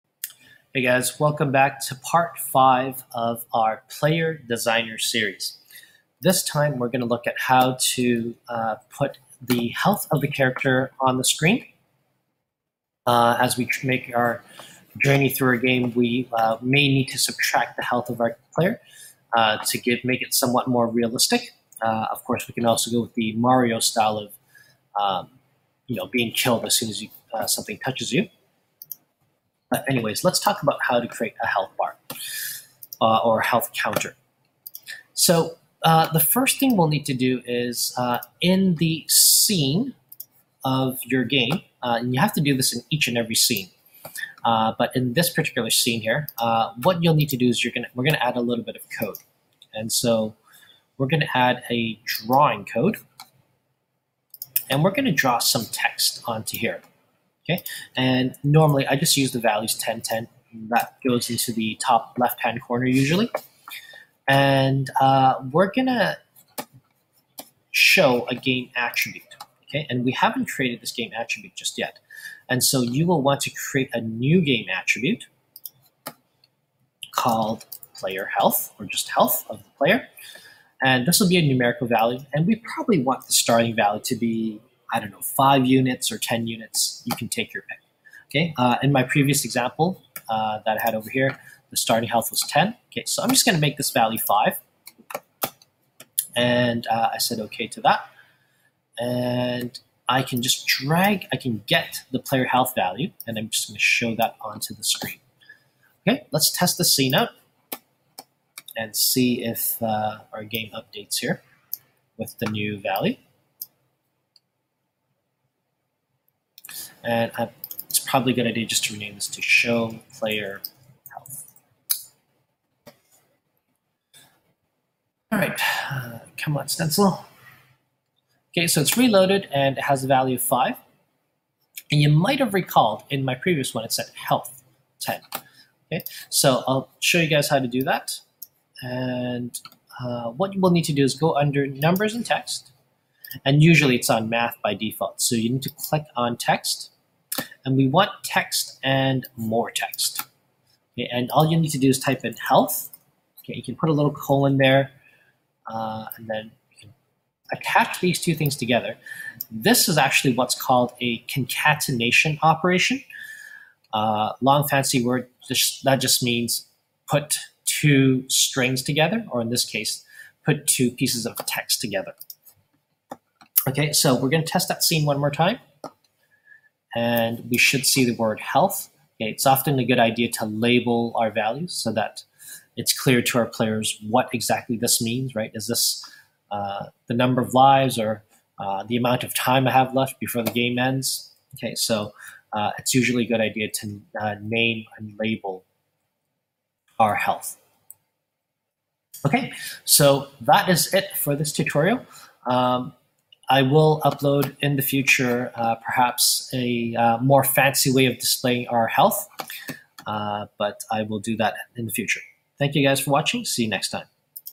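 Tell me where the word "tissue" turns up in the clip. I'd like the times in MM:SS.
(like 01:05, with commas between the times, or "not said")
not said.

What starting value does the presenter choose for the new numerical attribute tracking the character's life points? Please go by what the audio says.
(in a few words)
5.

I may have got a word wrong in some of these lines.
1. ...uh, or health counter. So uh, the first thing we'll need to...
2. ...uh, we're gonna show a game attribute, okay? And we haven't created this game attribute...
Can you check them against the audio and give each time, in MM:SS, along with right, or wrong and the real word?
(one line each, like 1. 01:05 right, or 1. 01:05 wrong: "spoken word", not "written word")
1. 00:33 right
2. 01:04 right.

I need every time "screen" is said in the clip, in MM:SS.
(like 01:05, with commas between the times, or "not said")
00:11, 01:44.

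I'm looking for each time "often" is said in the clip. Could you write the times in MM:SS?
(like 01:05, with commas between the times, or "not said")
02:59.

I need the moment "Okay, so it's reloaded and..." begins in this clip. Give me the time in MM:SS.
02:08.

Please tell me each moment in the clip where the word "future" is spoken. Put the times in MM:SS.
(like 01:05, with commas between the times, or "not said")
03:24, 03:31.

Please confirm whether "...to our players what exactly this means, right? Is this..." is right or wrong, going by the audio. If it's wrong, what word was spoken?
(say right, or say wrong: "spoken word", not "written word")
right.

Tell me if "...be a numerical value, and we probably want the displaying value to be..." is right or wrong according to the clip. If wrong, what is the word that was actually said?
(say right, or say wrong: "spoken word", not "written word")
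wrong: "starting", not "displaying".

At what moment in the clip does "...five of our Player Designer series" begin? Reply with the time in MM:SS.
00:02.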